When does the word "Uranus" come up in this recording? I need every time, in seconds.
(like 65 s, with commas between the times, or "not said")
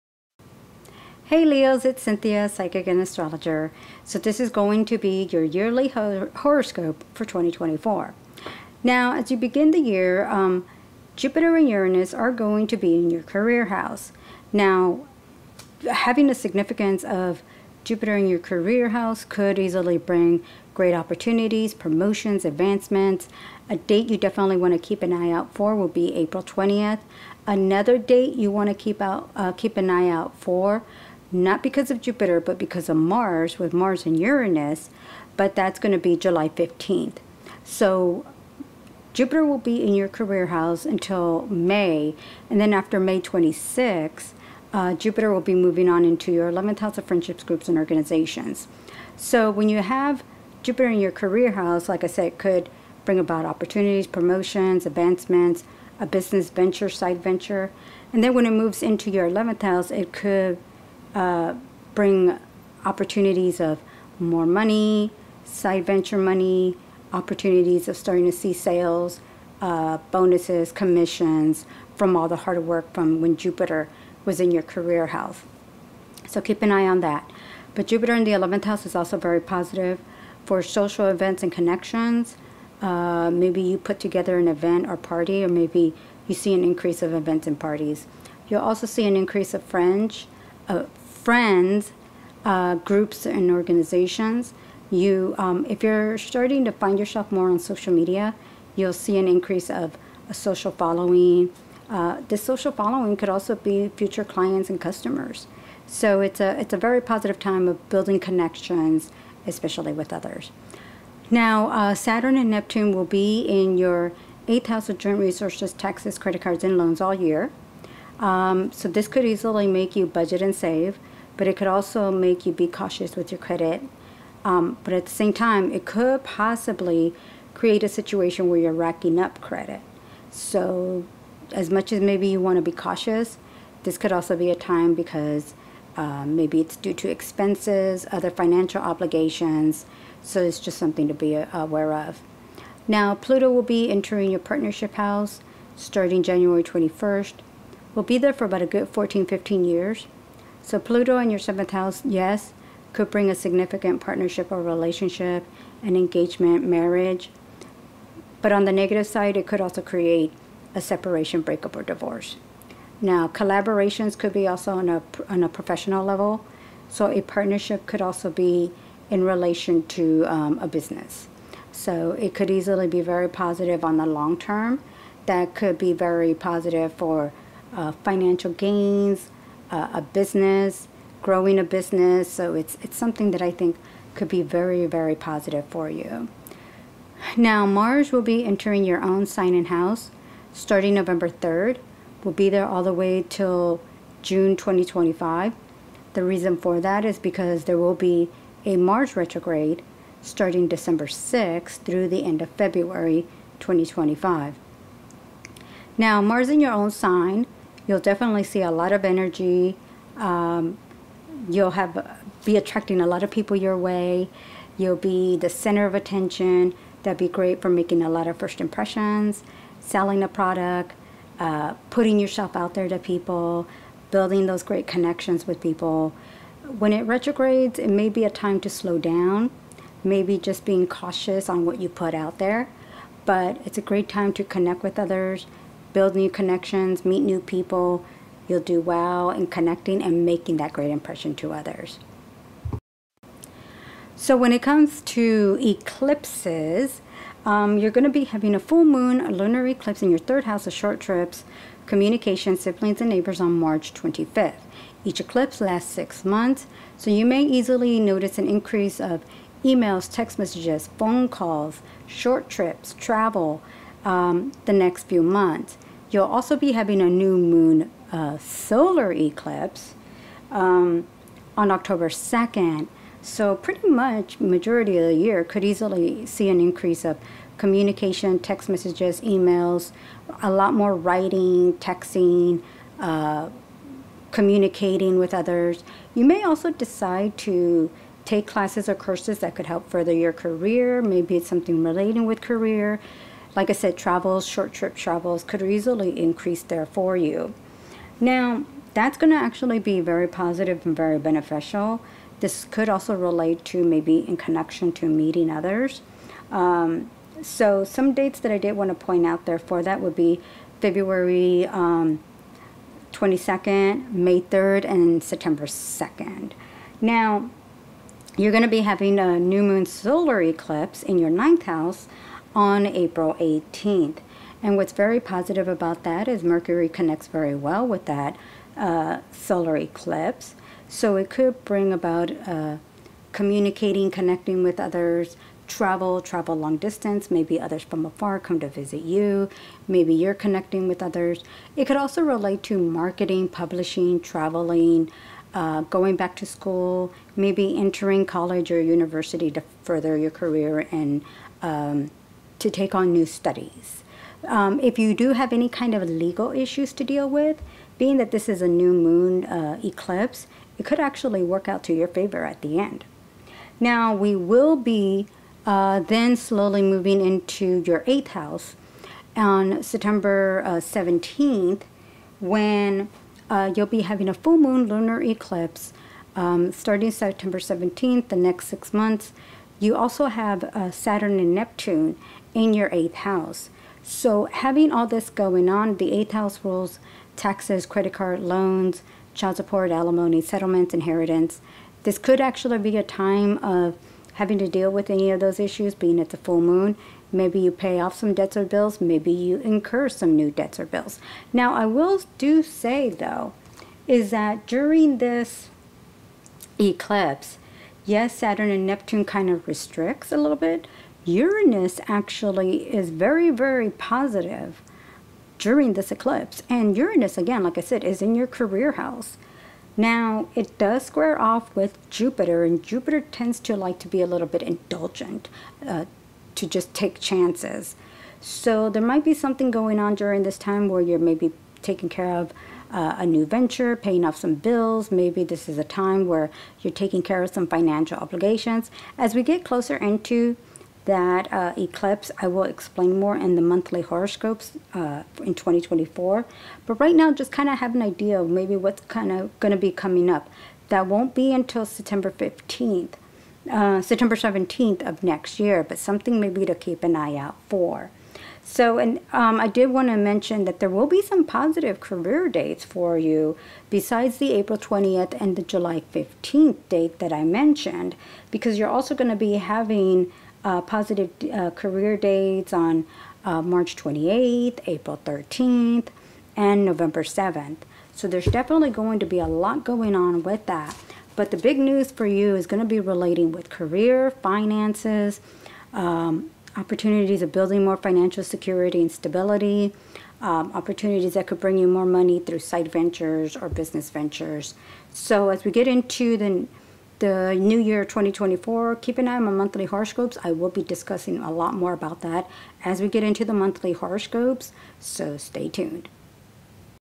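11 s, 34 s, 411 s, 416 s.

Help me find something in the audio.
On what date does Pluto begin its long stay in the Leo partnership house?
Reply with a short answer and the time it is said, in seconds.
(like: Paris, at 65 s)
January 21, at 146 s.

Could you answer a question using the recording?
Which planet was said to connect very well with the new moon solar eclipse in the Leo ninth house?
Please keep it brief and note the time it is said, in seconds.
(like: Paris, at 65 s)
Mercury, at 326 s.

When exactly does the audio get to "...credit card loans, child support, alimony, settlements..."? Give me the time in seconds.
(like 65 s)
387 s.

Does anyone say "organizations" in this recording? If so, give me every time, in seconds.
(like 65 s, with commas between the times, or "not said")
47 s, 93 s.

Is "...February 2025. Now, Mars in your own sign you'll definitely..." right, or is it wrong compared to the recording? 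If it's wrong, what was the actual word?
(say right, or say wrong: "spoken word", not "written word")
right.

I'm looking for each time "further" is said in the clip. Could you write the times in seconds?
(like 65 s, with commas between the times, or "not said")
289 s, 349 s.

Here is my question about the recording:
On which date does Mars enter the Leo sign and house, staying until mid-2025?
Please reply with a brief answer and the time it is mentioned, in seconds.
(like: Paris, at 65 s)
November 3, at 190 s.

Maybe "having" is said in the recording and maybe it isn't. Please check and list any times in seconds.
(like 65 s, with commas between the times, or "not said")
15 s, 248 s, 266 s, 318 s, 374 s, 384 s, 394 s, 469 s.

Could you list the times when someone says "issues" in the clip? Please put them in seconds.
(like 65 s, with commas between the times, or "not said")
356 s, 395 s.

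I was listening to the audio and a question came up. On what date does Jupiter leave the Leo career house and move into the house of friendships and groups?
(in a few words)
May 26.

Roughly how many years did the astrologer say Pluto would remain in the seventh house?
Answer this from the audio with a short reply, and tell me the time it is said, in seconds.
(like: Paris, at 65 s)
14 or 15 years, at 148 s.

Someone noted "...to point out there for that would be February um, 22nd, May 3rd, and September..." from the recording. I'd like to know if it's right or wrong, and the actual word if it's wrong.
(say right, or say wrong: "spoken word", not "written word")
right.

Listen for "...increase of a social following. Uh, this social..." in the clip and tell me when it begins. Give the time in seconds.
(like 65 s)
99 s.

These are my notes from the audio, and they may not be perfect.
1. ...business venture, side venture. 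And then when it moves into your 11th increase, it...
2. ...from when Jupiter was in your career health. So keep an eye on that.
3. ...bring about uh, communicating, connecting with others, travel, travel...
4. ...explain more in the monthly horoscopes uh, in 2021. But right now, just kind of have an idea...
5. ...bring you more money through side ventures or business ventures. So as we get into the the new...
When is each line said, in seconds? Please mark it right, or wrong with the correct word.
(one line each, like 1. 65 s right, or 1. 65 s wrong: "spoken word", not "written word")
1. 56 s wrong: "house", not "increase"
2. 72 s right
3. 331 s right
4. 442 s wrong: "2024", not "2021"
5. 491 s right.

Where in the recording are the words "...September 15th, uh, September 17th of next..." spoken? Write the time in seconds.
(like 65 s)
451 s.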